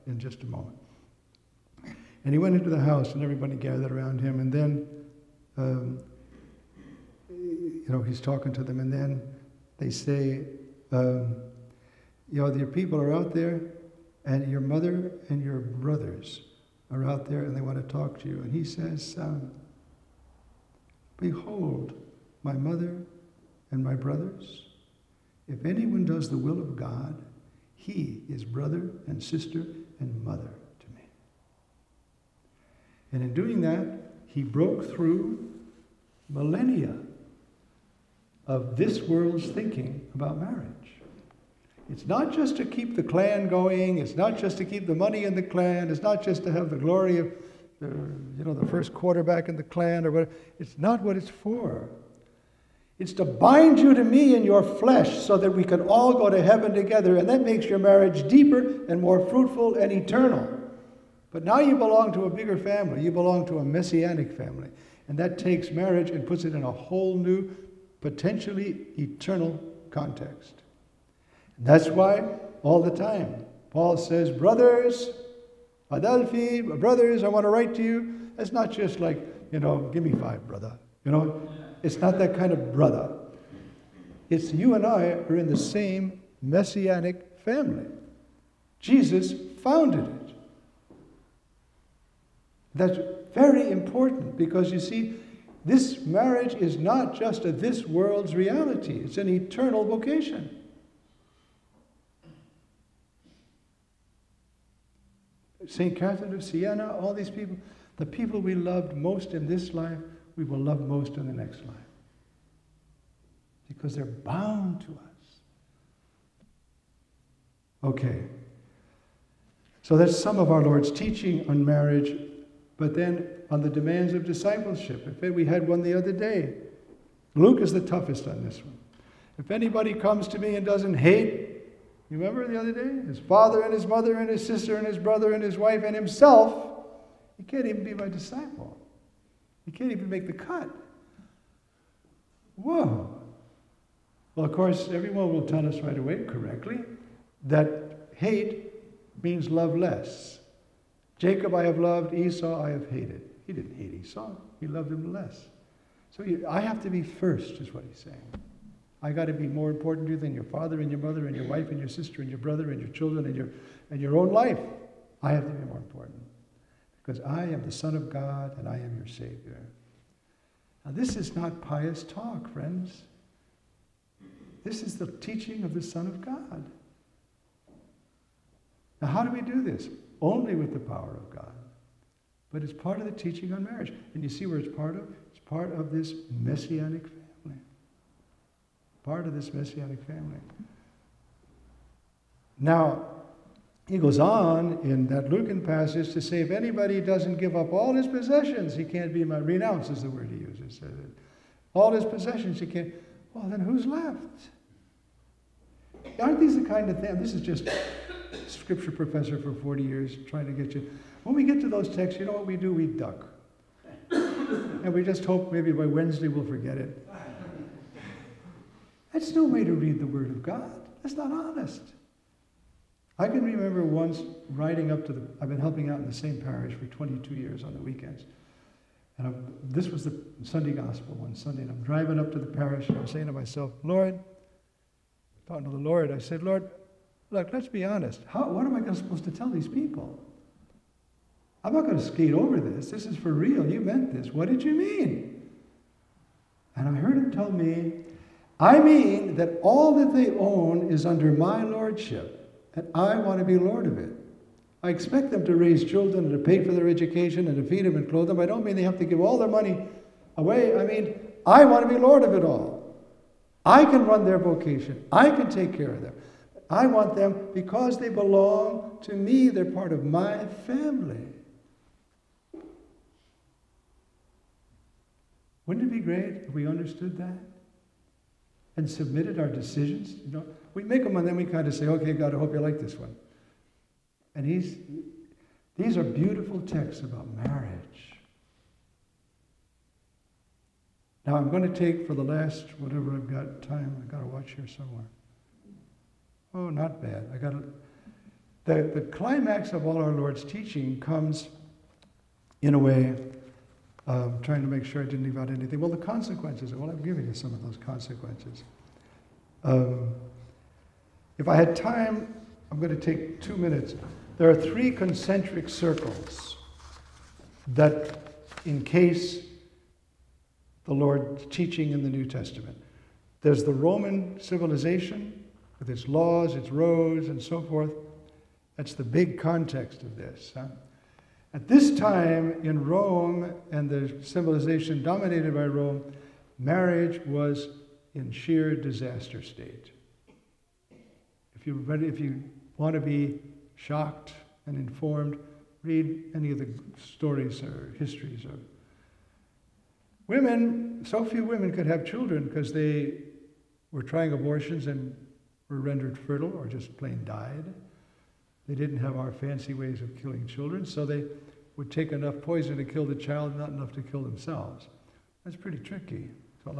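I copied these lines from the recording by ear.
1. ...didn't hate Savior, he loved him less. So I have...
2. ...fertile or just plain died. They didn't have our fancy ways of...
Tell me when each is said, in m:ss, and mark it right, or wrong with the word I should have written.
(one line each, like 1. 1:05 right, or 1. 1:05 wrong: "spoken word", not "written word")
1. 2:33 wrong: "Esau", not "Savior"
2. 5:56 right.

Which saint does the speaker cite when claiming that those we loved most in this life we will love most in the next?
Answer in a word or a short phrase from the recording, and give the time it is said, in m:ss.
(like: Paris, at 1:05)
St. Catherine of Siena, at 1:45.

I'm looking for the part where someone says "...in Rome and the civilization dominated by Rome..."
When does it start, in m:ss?
5:32.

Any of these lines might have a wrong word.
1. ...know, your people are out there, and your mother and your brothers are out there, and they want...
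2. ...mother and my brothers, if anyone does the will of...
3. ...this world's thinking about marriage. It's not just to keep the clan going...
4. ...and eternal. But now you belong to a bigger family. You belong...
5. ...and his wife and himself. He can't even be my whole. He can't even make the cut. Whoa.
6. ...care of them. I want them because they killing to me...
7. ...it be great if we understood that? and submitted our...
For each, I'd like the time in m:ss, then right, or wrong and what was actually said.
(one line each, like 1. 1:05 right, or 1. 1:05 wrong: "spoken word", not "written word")
1. 0:12 right
2. 0:22 right
3. 0:38 right
4. 0:59 right
5. 2:15 wrong: "disciple", not "whole"
6. 4:25 wrong: "belong", not "killing"
7. 4:35 right.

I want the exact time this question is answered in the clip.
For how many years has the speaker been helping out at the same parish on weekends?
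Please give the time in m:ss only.
3:46.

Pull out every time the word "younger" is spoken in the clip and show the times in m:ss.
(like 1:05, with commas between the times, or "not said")
not said.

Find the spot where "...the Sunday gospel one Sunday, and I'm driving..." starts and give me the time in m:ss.
3:50.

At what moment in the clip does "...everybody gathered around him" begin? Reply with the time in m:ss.
0:03.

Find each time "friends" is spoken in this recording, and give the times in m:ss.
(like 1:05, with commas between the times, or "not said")
2:52.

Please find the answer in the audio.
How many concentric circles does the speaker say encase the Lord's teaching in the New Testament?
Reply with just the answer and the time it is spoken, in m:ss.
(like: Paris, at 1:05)
3, at 5:14.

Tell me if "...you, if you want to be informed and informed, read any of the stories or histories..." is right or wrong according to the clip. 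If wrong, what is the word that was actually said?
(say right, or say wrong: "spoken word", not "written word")
wrong: "shocked", not "informed".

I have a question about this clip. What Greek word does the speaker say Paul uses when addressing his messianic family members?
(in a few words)
Adelphi.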